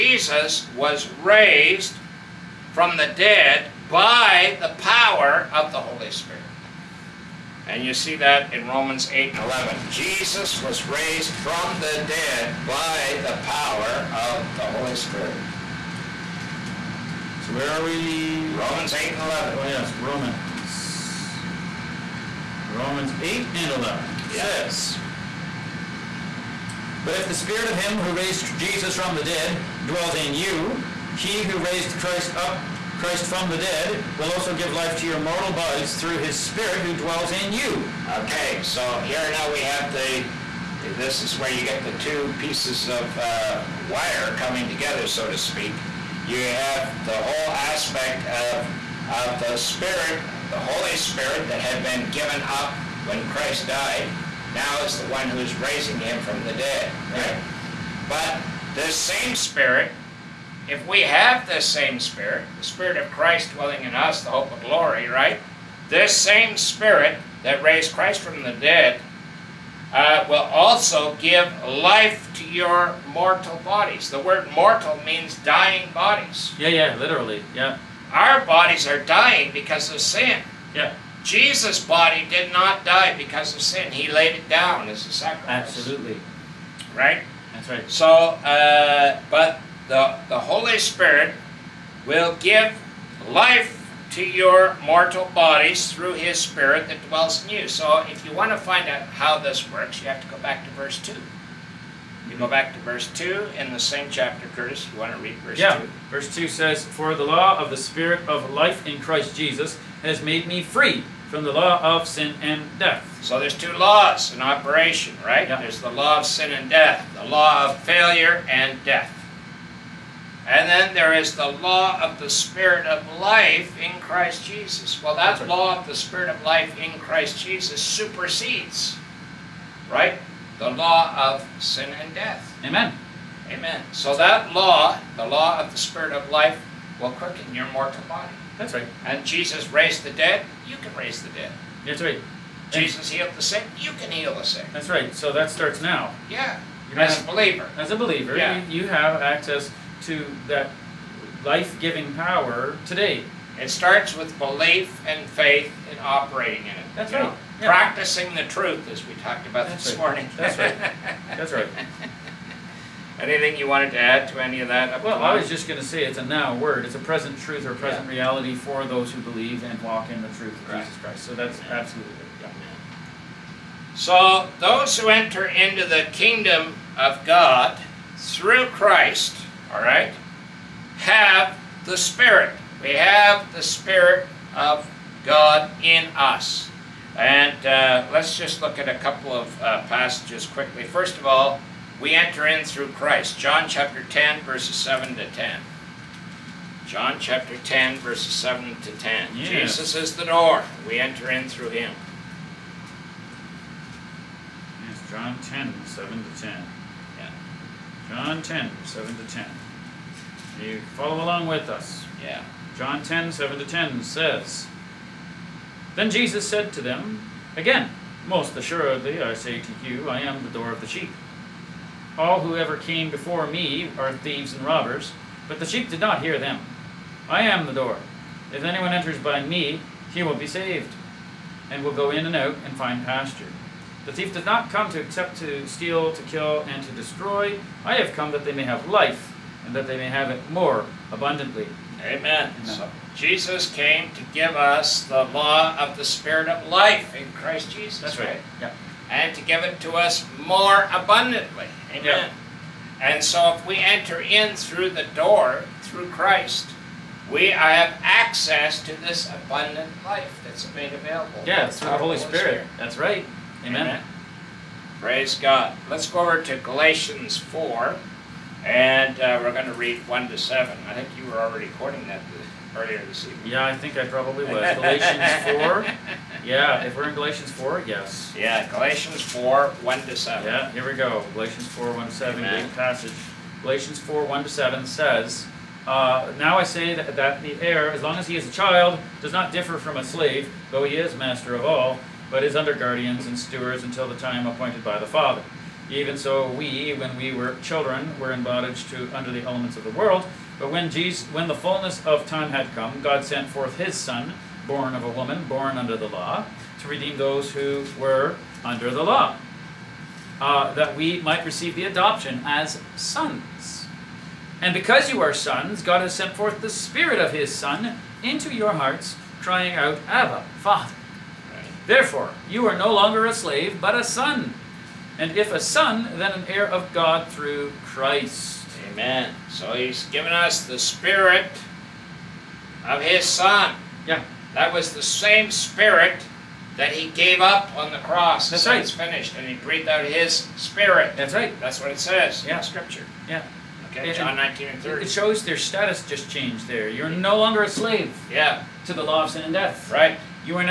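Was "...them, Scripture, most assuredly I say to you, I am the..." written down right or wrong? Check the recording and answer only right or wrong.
wrong.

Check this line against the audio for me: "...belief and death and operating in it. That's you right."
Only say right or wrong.
wrong.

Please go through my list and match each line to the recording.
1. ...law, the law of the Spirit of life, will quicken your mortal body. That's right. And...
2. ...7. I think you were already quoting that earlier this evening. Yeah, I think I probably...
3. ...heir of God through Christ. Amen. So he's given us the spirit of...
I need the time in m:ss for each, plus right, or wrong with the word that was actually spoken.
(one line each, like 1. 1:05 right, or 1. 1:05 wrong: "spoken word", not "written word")
1. 2:14 right
2. 4:30 right
3. 5:26 right.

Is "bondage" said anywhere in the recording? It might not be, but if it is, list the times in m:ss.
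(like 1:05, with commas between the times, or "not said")
4:58.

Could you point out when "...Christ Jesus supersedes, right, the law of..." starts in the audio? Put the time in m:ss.
2:06.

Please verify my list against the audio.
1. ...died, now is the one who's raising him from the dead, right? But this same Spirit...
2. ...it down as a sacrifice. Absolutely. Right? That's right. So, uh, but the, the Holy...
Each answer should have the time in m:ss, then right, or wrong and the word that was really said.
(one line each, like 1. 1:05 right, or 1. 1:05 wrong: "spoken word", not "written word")
1. 0:53 right
2. 1:24 right.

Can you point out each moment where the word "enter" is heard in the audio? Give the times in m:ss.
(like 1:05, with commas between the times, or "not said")
2:55, 3:12, 3:21, 3:48, 4:13.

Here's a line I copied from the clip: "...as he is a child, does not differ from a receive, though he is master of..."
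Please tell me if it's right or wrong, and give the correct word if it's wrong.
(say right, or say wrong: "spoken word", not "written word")
wrong: "slave", not "receive".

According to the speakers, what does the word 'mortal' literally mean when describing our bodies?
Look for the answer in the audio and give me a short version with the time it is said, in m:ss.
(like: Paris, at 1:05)
dying bodies, at 1:15.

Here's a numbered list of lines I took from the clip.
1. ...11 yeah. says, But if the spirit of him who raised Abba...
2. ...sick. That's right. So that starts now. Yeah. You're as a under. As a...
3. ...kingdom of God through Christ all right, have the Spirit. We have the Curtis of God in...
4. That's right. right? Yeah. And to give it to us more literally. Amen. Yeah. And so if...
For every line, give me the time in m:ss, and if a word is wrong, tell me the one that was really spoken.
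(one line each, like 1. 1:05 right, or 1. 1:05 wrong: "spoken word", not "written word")
1. 0:23 wrong: "Jesus", not "Abba"
2. 2:24 wrong: "believer", not "under"
3. 2:56 wrong: "Spirit", not "Curtis"
4. 4:08 wrong: "abundantly", not "literally".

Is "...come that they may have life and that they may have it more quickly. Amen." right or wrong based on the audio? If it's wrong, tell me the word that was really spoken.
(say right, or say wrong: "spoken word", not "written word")
wrong: "abundantly", not "quickly".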